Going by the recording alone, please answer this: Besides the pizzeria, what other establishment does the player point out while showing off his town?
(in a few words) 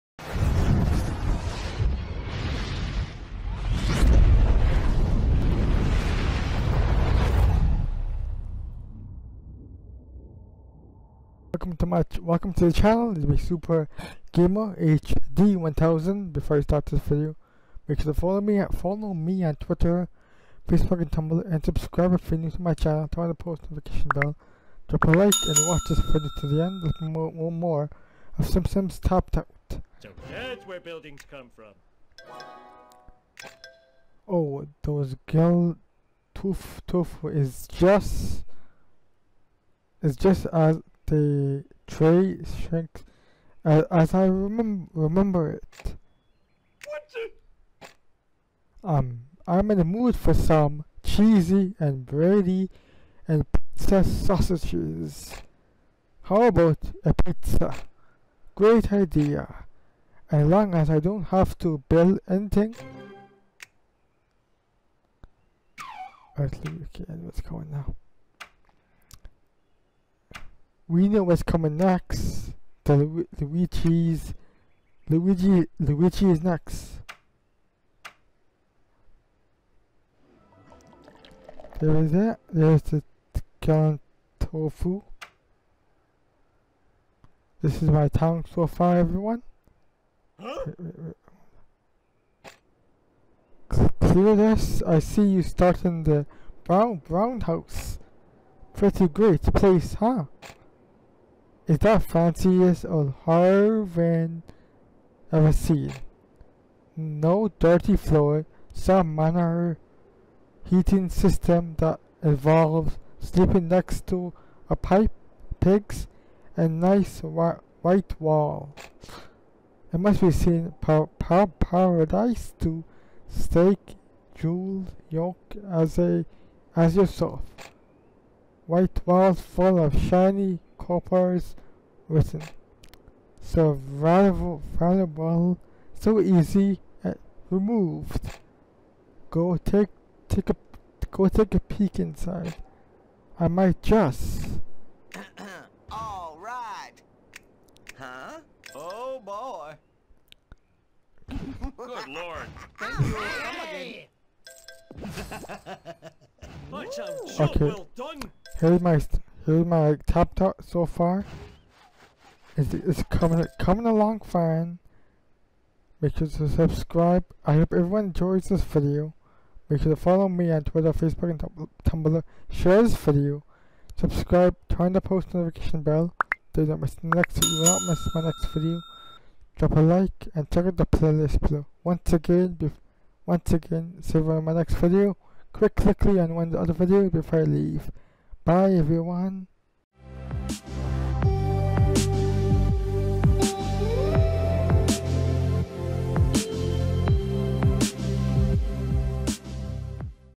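The Gilded Truffle.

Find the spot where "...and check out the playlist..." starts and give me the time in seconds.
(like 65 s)
180 s.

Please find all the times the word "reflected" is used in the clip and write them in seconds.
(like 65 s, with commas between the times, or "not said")
not said.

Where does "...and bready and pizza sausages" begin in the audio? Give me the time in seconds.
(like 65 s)
51 s.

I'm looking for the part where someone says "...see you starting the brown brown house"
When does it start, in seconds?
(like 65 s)
94 s.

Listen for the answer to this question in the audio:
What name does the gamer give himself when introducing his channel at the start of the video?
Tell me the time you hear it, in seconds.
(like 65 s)
13 s.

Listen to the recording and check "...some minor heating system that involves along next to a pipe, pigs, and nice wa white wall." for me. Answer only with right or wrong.
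wrong.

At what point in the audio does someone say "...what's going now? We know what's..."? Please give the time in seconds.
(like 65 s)
67 s.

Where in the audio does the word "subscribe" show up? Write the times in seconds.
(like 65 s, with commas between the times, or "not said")
21 s, 166 s, 173 s.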